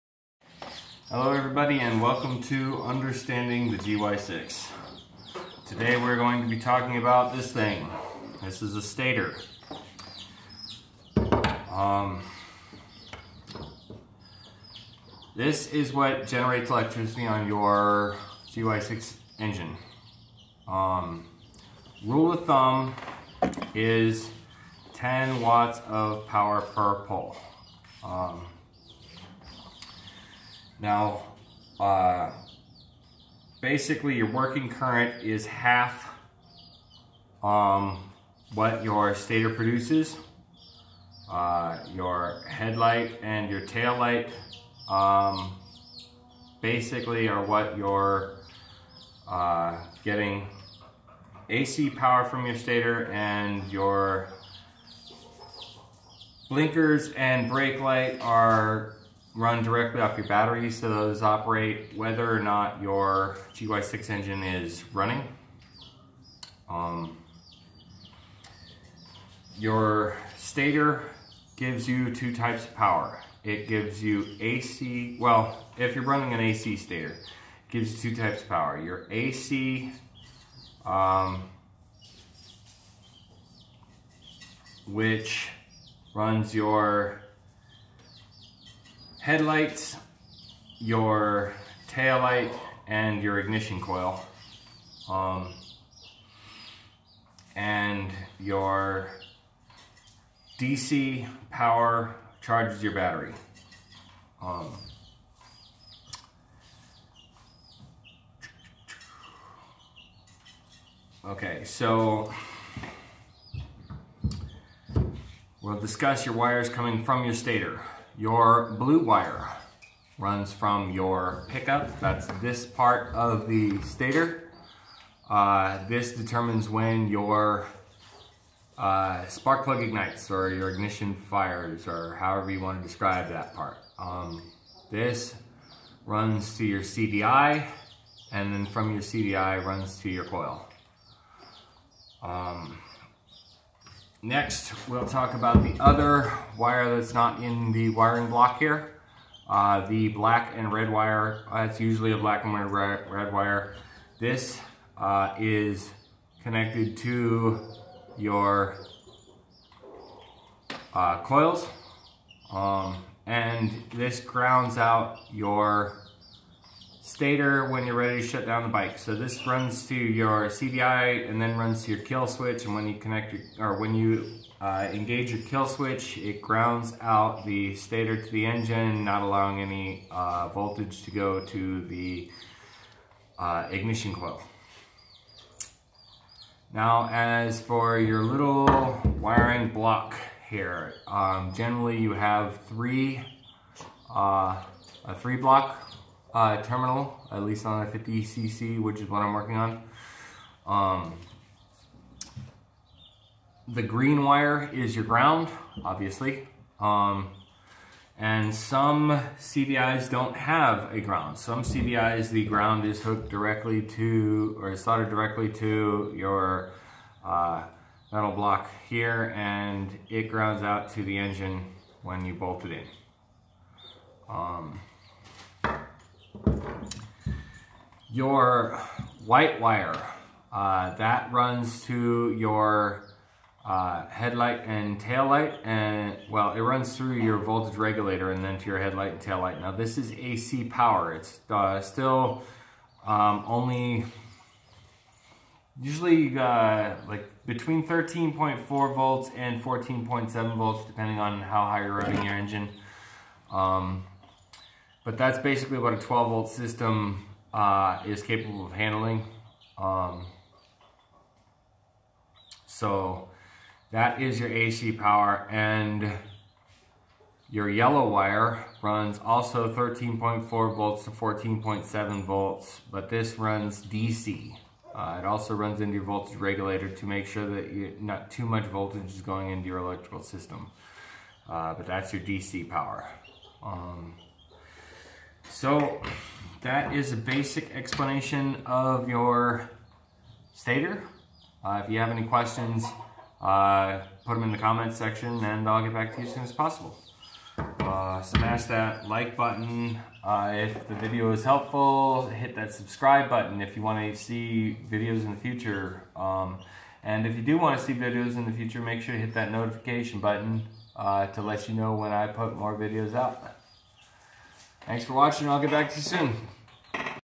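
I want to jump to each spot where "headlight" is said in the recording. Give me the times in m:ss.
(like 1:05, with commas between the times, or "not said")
0:42, 1:29, 3:54, 3:58.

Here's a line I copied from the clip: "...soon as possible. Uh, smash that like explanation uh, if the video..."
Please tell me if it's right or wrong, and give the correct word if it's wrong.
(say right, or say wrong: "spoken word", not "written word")
wrong: "button", not "explanation".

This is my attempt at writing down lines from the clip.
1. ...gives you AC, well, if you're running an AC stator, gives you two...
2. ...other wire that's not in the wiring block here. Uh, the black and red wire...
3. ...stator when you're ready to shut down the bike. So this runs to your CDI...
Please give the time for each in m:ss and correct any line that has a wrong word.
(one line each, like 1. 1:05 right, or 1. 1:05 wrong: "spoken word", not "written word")
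1. 1:13 right
2. 2:25 right
3. 2:47 right.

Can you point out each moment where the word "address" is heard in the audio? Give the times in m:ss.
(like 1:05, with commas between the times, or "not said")
not said.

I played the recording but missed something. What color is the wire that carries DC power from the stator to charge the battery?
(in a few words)
yellow.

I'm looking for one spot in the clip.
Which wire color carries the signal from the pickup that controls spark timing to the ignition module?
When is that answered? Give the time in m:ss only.
1:58.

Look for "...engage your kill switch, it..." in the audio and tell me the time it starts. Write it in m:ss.
2:54.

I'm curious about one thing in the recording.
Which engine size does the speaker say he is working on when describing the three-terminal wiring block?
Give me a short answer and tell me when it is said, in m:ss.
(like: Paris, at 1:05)
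50cc, at 3:17.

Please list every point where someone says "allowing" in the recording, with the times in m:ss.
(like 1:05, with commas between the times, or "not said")
2:59.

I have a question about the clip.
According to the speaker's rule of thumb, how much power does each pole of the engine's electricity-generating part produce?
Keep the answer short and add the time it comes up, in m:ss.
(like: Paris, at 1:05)
10 watts, at 0:24.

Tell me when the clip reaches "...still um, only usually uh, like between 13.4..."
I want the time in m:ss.
4:01.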